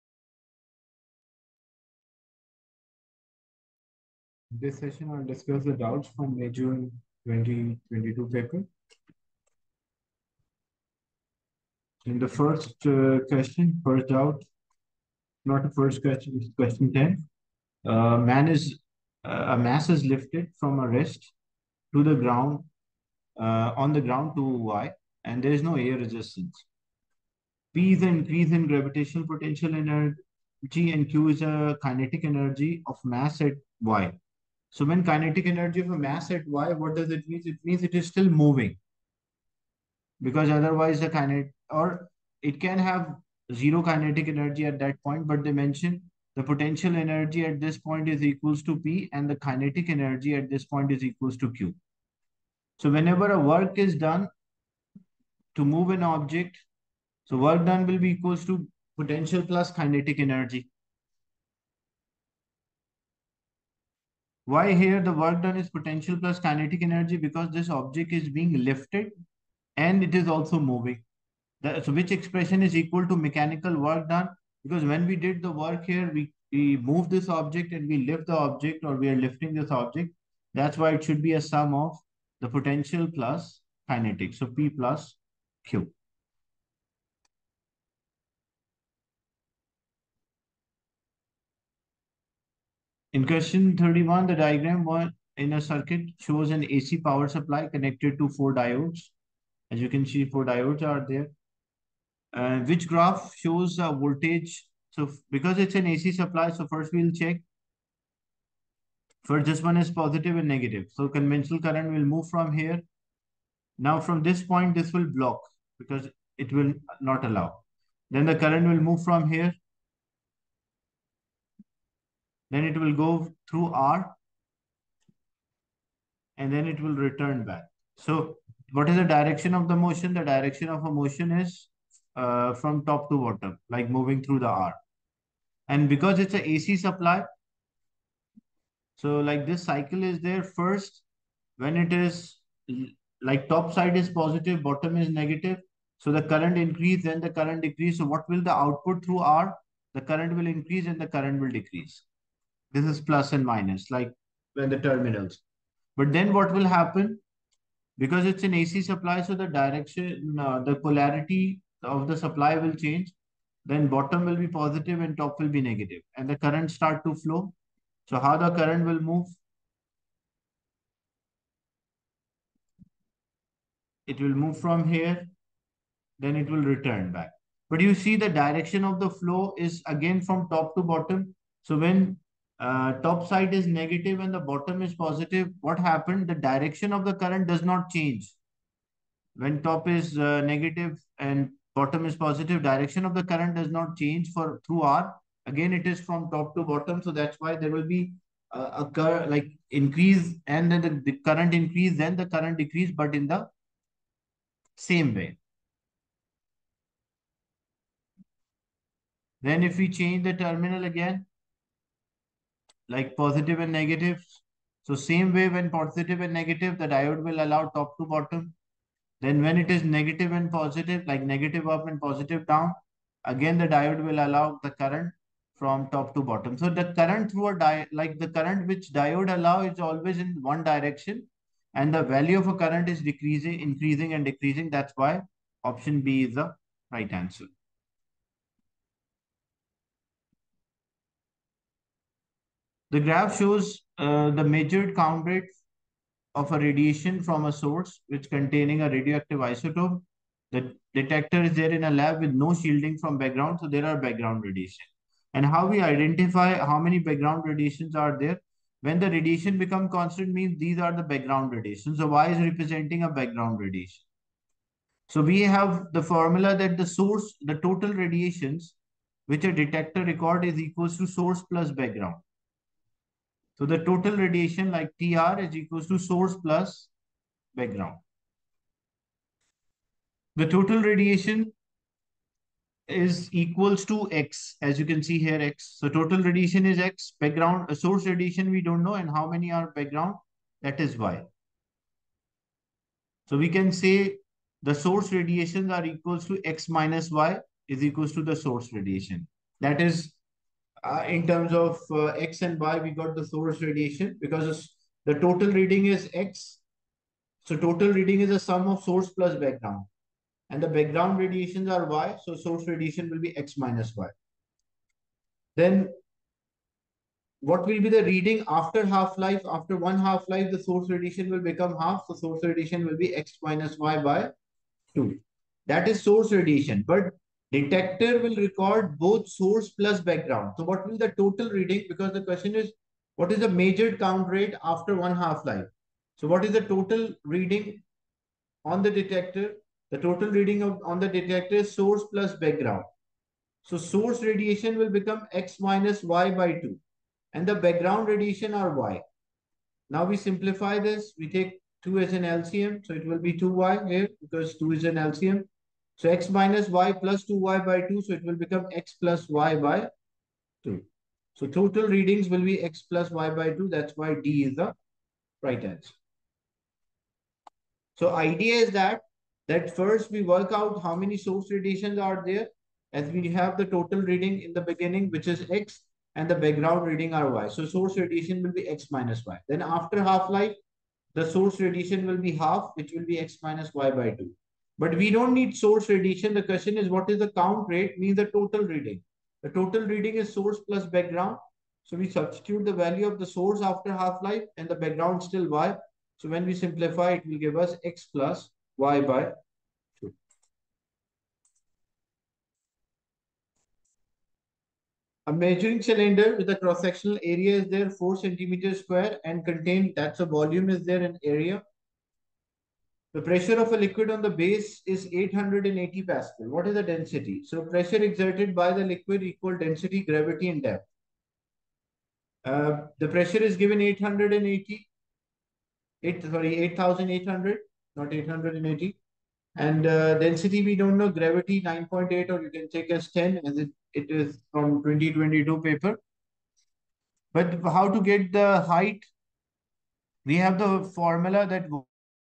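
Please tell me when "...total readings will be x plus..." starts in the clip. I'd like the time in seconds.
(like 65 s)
361 s.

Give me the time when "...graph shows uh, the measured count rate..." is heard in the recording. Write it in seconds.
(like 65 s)
242 s.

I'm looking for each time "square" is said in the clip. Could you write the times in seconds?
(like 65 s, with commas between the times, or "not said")
408 s.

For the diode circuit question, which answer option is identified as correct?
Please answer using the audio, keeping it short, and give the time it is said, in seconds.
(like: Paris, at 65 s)
B, at 235 s.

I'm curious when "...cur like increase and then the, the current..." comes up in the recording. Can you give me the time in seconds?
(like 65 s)
198 s.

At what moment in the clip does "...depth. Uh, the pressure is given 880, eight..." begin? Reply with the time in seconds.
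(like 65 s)
420 s.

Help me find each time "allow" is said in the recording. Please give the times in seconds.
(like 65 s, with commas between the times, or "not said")
117 s, 217 s, 224 s, 229 s.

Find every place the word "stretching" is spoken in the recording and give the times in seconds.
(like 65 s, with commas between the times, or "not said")
not said.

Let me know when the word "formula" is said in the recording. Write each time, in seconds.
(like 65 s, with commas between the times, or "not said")
266 s, 440 s.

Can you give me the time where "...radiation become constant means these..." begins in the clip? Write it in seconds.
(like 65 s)
259 s.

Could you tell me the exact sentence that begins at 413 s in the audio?
The pressure of a liquid on the base is 880 Pascal.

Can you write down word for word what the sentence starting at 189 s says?
When top is uh, negative and bottom is positive, direction of the current does not change for through R.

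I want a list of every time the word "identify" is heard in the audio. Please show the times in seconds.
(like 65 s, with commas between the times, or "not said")
255 s.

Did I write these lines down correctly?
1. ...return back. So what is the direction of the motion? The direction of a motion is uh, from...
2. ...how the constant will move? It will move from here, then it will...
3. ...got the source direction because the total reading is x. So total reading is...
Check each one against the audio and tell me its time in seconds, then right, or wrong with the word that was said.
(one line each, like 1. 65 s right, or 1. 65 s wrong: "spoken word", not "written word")
1. 126 s right
2. 168 s wrong: "current", not "constant"
3. 302 s wrong: "radiation", not "direction".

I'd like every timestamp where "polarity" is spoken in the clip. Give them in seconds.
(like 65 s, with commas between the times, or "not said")
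160 s.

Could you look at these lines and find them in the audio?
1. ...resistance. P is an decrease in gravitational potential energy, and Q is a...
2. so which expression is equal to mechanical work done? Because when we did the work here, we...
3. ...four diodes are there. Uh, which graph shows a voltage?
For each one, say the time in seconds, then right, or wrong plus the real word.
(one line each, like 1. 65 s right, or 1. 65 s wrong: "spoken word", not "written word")
1. 25 s wrong: "increase", not "decrease"
2. 71 s right
3. 100 s right.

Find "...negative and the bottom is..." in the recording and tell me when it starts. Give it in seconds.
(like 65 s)
183 s.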